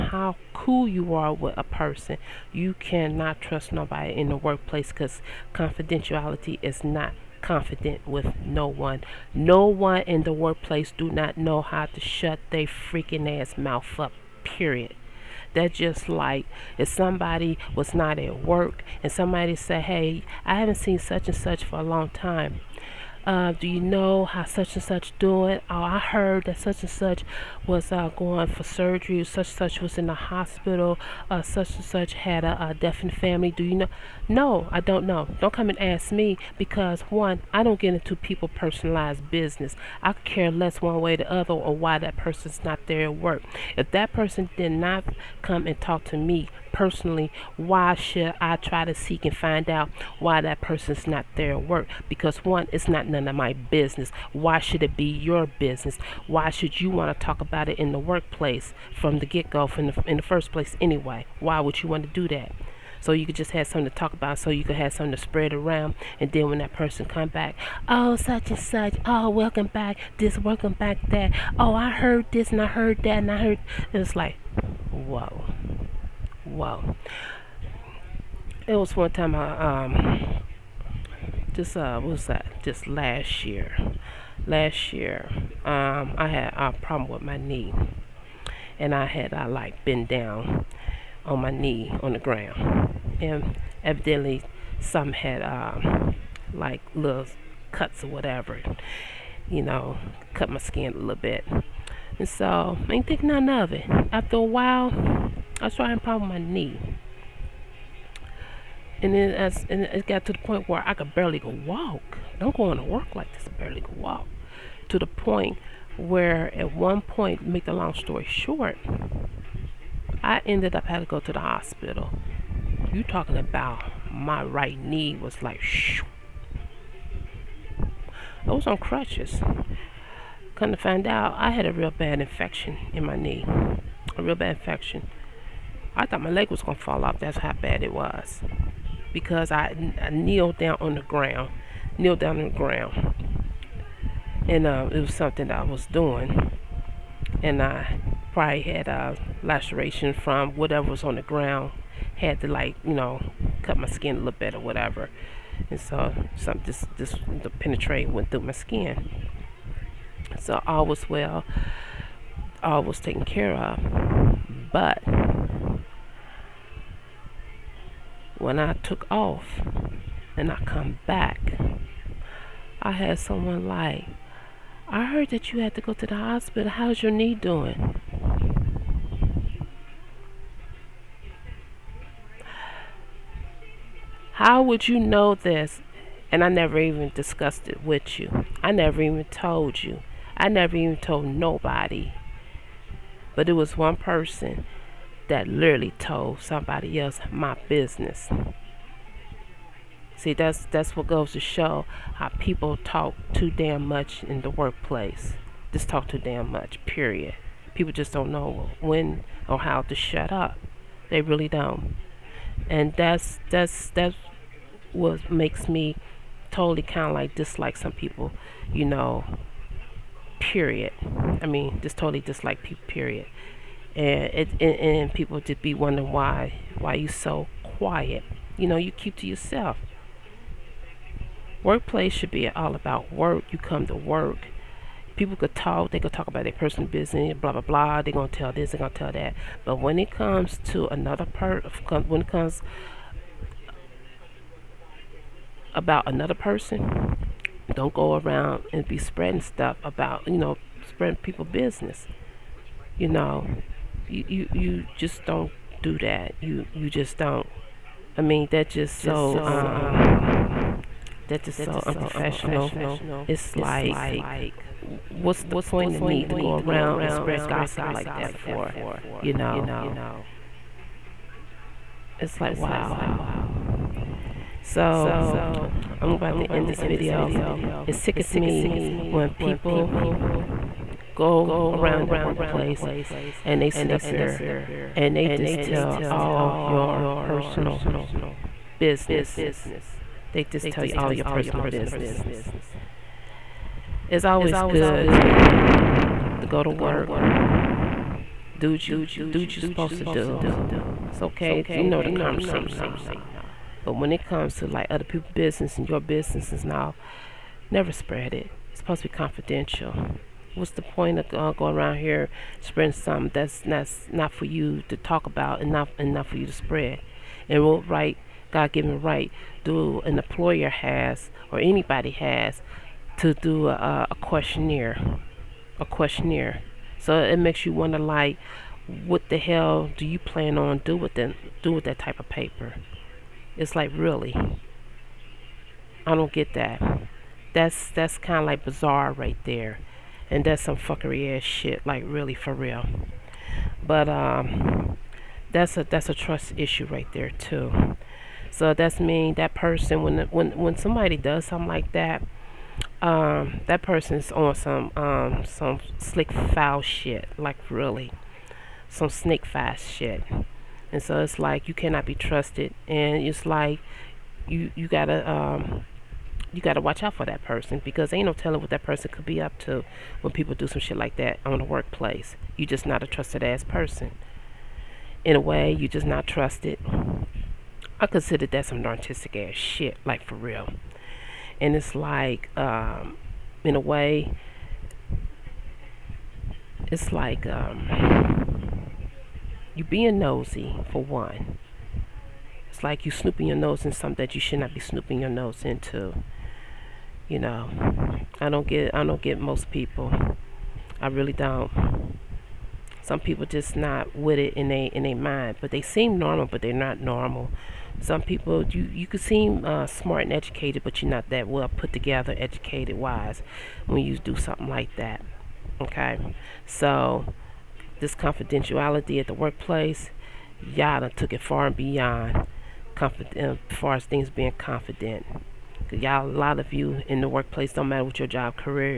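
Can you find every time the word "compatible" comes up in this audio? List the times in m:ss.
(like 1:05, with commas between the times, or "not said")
not said.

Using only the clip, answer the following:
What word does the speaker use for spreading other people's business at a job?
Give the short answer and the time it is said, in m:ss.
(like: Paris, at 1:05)
unprofessional, at 4:21.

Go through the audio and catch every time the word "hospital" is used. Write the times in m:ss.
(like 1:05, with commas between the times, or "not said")
0:30, 2:01, 2:56.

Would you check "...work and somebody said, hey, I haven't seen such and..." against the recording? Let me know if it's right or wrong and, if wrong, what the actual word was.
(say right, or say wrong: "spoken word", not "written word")
right.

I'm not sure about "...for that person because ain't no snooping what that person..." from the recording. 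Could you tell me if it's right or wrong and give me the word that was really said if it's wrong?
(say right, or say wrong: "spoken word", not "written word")
wrong: "telling", not "snooping".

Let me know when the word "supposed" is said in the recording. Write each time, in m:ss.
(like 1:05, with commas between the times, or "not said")
4:59, 5:08.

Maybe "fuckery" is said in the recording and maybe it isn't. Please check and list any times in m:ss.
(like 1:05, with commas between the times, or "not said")
5:40.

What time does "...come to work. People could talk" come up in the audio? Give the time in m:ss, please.
3:53.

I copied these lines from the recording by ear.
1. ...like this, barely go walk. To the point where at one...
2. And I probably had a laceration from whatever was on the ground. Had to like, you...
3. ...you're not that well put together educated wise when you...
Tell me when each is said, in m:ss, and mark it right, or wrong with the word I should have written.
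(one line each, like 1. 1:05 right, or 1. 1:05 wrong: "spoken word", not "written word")
1. 1:53 right
2. 2:27 right
3. 6:51 right.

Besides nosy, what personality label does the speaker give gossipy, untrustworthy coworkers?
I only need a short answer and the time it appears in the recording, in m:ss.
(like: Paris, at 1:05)
narcissistic, at 6:18.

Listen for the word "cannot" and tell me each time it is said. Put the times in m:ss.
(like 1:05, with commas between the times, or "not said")
0:02, 6:01.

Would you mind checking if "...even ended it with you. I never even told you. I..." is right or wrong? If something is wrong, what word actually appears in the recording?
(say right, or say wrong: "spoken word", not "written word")
wrong: "discussed", not "ended".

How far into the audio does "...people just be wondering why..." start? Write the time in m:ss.
3:45.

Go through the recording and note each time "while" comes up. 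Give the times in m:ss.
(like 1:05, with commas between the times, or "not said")
1:44.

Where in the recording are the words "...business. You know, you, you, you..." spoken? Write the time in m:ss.
4:11.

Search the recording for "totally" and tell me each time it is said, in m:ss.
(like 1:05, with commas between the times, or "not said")
3:36, 3:41.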